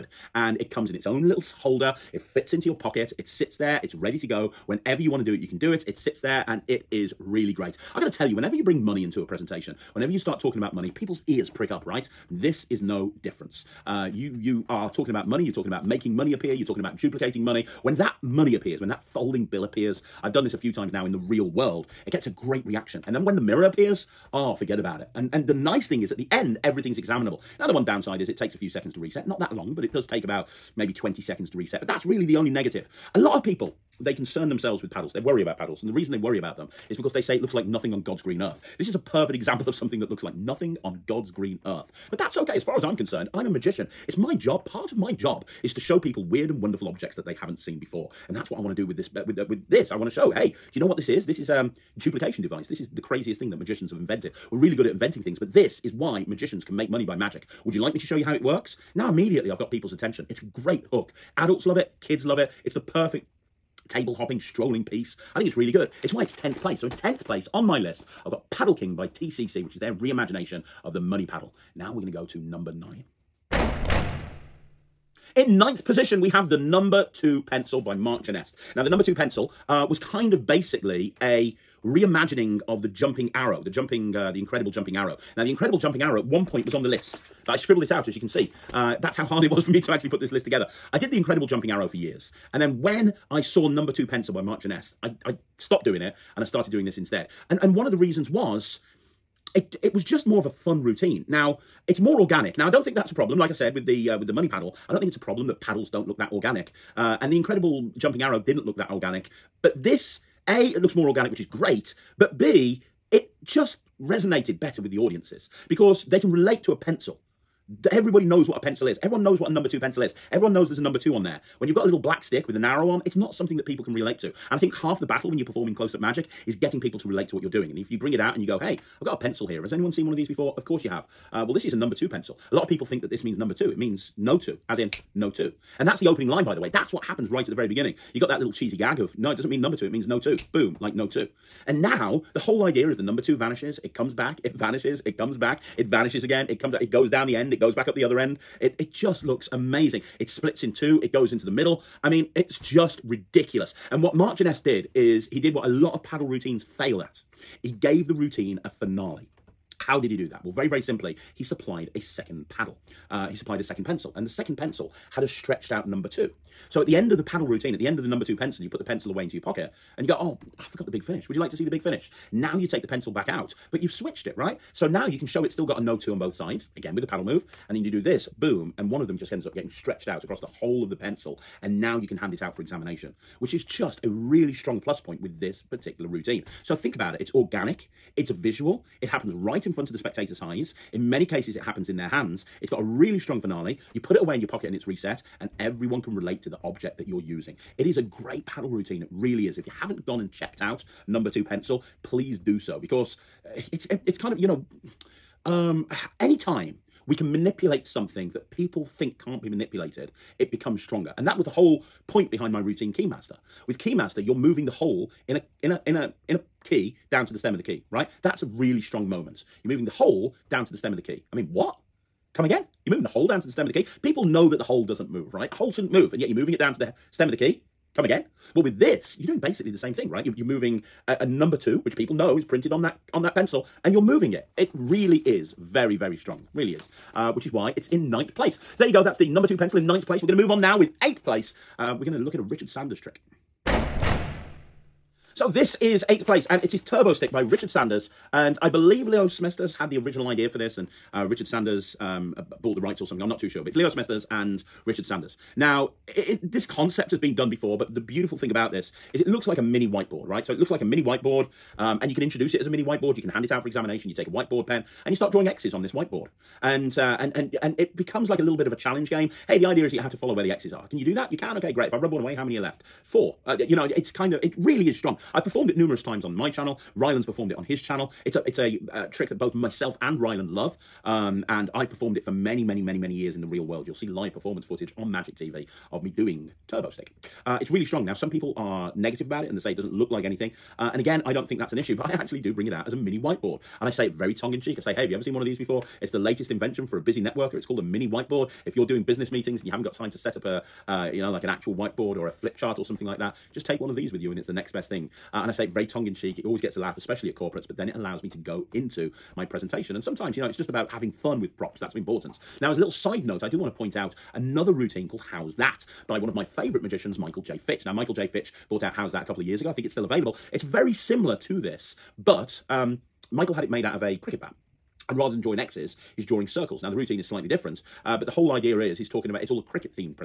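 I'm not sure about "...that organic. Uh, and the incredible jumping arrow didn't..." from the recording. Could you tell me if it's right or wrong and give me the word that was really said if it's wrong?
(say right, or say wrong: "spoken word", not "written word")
right.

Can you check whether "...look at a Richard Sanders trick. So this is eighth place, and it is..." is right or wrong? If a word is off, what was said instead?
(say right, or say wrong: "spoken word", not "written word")
right.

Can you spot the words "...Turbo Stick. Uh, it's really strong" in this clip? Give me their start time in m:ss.
4:46.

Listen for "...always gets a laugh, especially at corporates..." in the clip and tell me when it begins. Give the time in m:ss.
5:06.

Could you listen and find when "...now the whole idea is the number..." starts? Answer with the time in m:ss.
2:21.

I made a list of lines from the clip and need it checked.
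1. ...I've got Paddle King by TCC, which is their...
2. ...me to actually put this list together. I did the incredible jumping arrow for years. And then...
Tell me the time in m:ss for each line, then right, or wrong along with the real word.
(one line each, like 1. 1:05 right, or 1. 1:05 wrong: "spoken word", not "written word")
1. 1:08 right
2. 1:29 right.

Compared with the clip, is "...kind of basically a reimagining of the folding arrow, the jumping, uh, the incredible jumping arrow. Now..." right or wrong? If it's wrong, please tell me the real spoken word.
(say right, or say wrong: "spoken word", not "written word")
wrong: "jumping", not "folding".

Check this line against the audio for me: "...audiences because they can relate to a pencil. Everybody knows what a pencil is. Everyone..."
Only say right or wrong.
right.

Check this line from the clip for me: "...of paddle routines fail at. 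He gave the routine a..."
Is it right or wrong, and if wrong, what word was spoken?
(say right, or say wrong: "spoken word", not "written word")
right.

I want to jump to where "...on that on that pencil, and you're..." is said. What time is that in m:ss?
3:52.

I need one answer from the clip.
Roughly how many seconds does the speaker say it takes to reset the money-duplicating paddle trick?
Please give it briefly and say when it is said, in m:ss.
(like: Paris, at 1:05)
20, at 0:30.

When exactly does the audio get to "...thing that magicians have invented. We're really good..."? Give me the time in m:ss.
0:53.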